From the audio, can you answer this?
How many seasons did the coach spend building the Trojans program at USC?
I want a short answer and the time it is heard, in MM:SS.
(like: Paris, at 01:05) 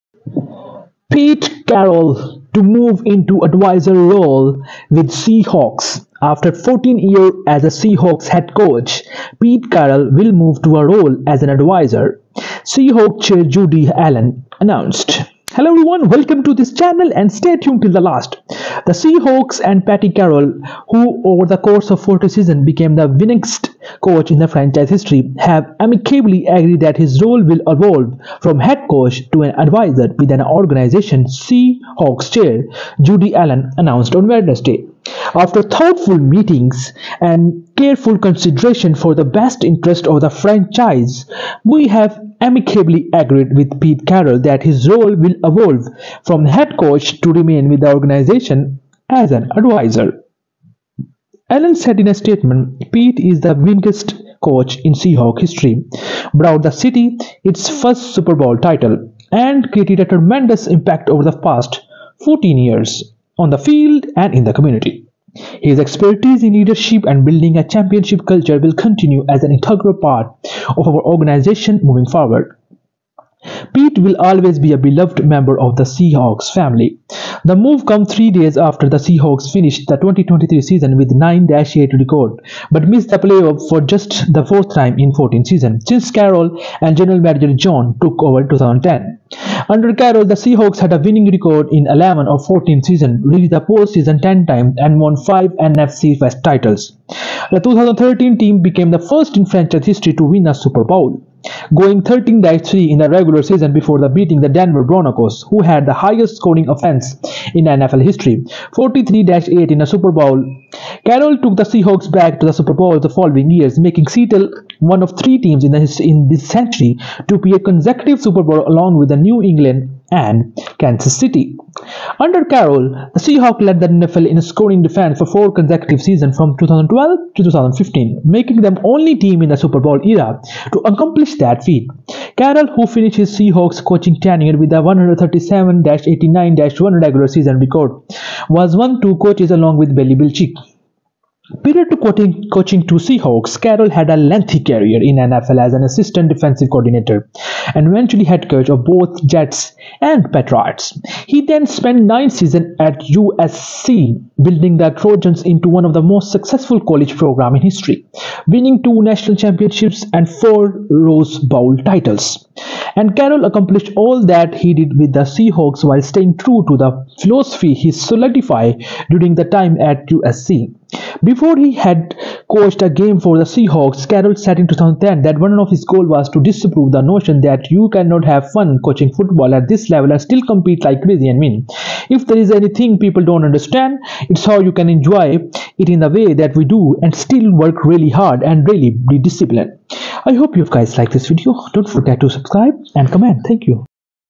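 nine, at 02:32.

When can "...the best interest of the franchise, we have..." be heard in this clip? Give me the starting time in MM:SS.
00:39.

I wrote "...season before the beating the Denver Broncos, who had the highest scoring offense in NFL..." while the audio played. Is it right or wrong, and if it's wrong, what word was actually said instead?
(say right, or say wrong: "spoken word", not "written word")
right.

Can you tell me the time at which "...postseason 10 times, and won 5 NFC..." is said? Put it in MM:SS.
01:33.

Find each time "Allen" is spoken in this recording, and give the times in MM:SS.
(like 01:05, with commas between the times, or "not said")
00:13, 00:33, 00:51.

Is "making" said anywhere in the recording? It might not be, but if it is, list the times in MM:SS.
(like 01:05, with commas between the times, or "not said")
01:53, 02:08.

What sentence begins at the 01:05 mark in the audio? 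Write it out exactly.
His expertise in leadership and building a championship culture will continue as an integral part of our organization moving forward.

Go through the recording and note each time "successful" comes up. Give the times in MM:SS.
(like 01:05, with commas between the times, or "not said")
02:36.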